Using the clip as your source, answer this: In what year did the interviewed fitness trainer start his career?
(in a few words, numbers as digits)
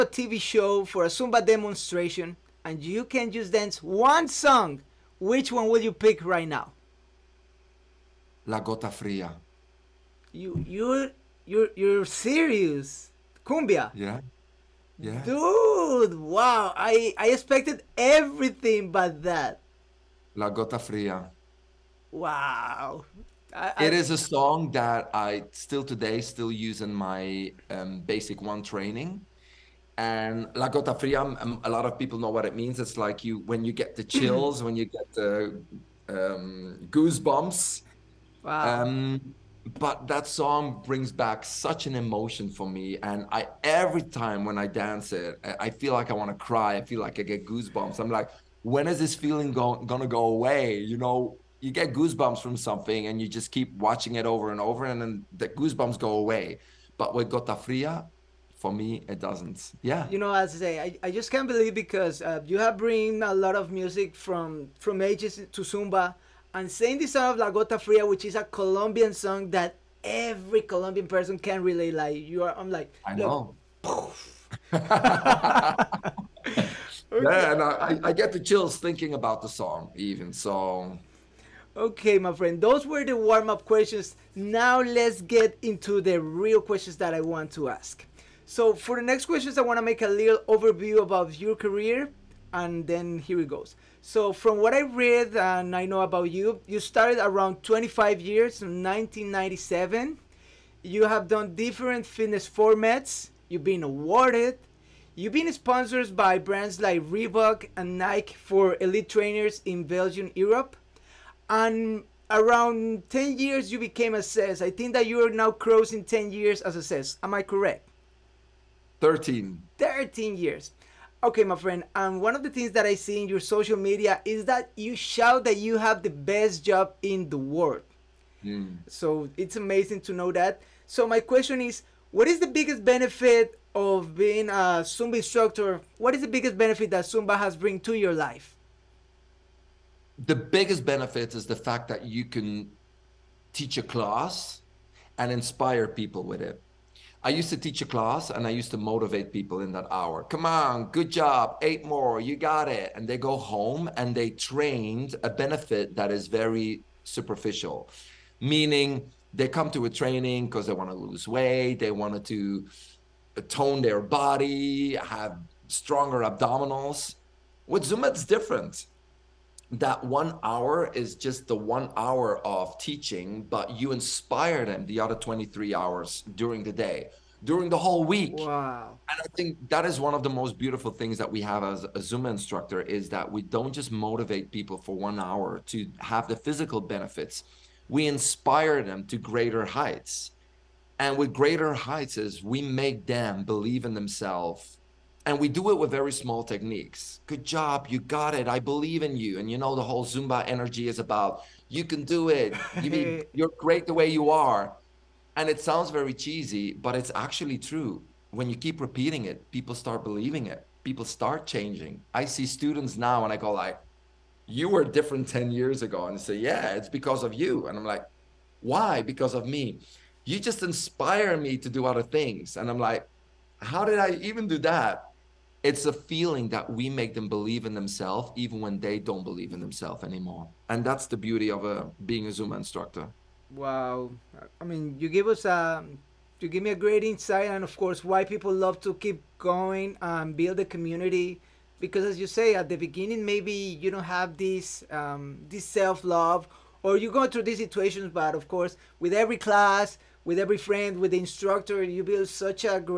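1997.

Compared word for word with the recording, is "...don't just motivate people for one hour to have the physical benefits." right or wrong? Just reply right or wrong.
right.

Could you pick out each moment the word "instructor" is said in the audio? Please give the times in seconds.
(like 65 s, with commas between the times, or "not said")
135 s, 182 s, 232 s, 251 s.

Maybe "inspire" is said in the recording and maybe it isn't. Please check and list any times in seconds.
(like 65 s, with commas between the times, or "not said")
145 s, 173 s, 188 s, 220 s.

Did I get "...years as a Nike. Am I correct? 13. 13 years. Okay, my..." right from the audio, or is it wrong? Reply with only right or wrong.
wrong.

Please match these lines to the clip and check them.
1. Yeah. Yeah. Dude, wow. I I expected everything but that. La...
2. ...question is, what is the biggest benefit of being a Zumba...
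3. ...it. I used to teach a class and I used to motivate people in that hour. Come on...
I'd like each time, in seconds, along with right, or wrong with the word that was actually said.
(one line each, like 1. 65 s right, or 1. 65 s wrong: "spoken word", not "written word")
1. 13 s right
2. 131 s right
3. 146 s right.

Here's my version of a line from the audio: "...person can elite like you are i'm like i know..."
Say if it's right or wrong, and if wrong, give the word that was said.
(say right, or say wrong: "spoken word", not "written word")
wrong: "relate", not "elite".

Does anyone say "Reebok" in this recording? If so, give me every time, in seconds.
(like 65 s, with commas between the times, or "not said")
107 s.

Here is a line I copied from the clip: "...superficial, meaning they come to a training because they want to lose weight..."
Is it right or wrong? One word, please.
right.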